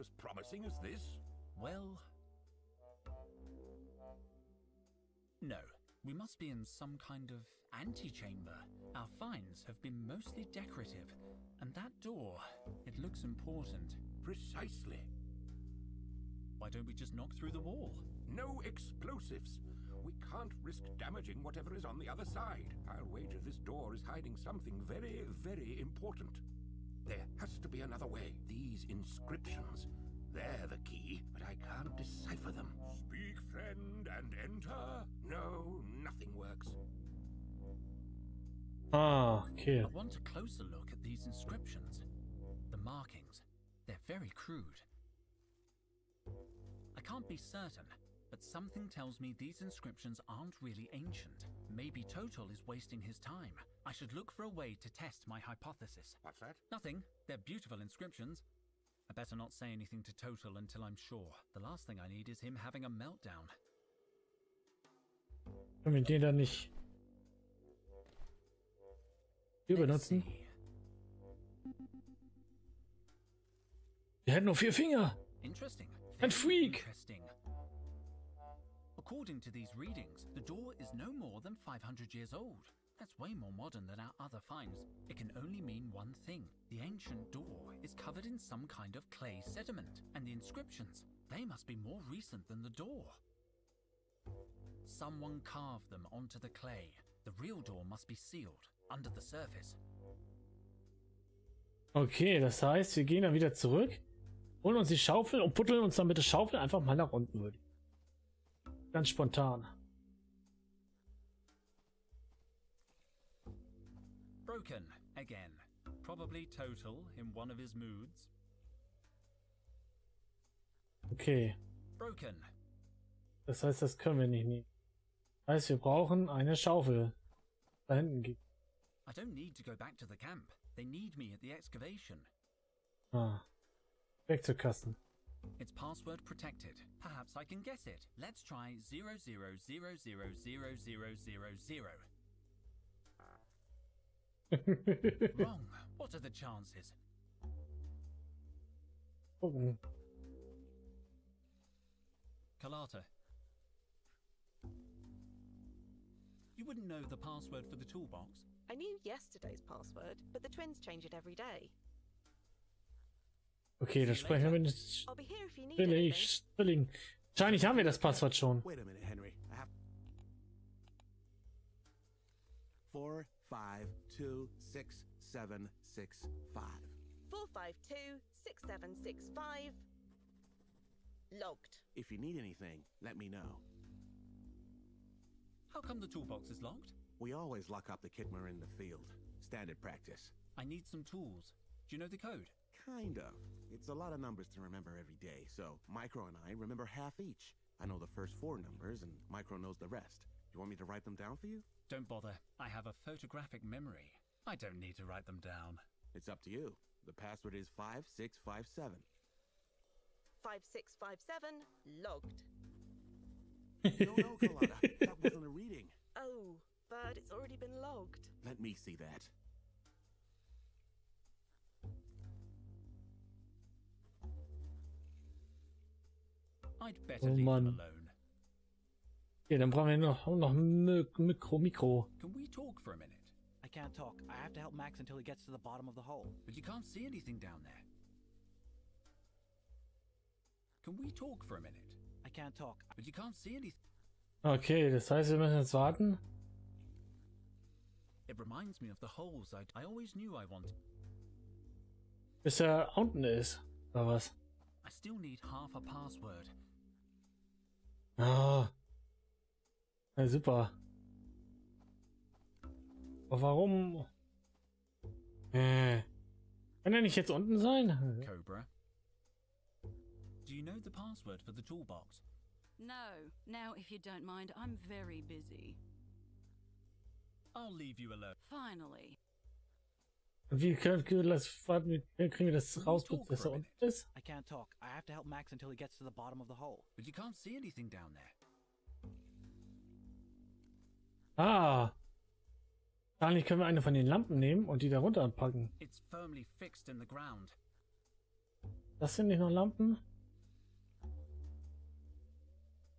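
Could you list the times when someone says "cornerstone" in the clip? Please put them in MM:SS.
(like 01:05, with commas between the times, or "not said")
not said.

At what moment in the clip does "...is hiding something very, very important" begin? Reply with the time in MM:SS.
00:23.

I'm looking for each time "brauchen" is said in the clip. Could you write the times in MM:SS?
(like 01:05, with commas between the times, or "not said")
02:05, 03:49.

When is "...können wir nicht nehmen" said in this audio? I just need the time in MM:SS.
02:03.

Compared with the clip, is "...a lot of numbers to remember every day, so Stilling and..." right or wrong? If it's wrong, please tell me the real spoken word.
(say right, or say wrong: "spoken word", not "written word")
wrong: "Micro", not "Stilling".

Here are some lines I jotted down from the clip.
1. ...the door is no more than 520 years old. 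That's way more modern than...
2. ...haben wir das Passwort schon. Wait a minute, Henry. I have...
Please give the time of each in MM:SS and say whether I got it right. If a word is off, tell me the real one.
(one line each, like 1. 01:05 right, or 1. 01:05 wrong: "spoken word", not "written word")
1. 01:20 wrong: "500", not "520"
2. 02:47 right.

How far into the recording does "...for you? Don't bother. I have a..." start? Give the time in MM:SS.
03:21.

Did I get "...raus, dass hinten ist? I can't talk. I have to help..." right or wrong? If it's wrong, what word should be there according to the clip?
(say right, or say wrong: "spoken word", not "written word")
wrong: "unten", not "hinten".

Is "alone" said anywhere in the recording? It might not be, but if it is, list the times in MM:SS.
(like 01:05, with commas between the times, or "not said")
03:47, 04:38.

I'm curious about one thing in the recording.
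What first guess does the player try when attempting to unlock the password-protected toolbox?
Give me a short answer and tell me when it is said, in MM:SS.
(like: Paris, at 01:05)
00000000, at 02:18.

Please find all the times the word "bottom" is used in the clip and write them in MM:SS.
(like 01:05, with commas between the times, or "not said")
03:55, 04:46.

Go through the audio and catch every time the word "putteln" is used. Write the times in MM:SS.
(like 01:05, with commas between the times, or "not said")
01:45.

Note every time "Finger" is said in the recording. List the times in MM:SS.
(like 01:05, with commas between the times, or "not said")
01:14.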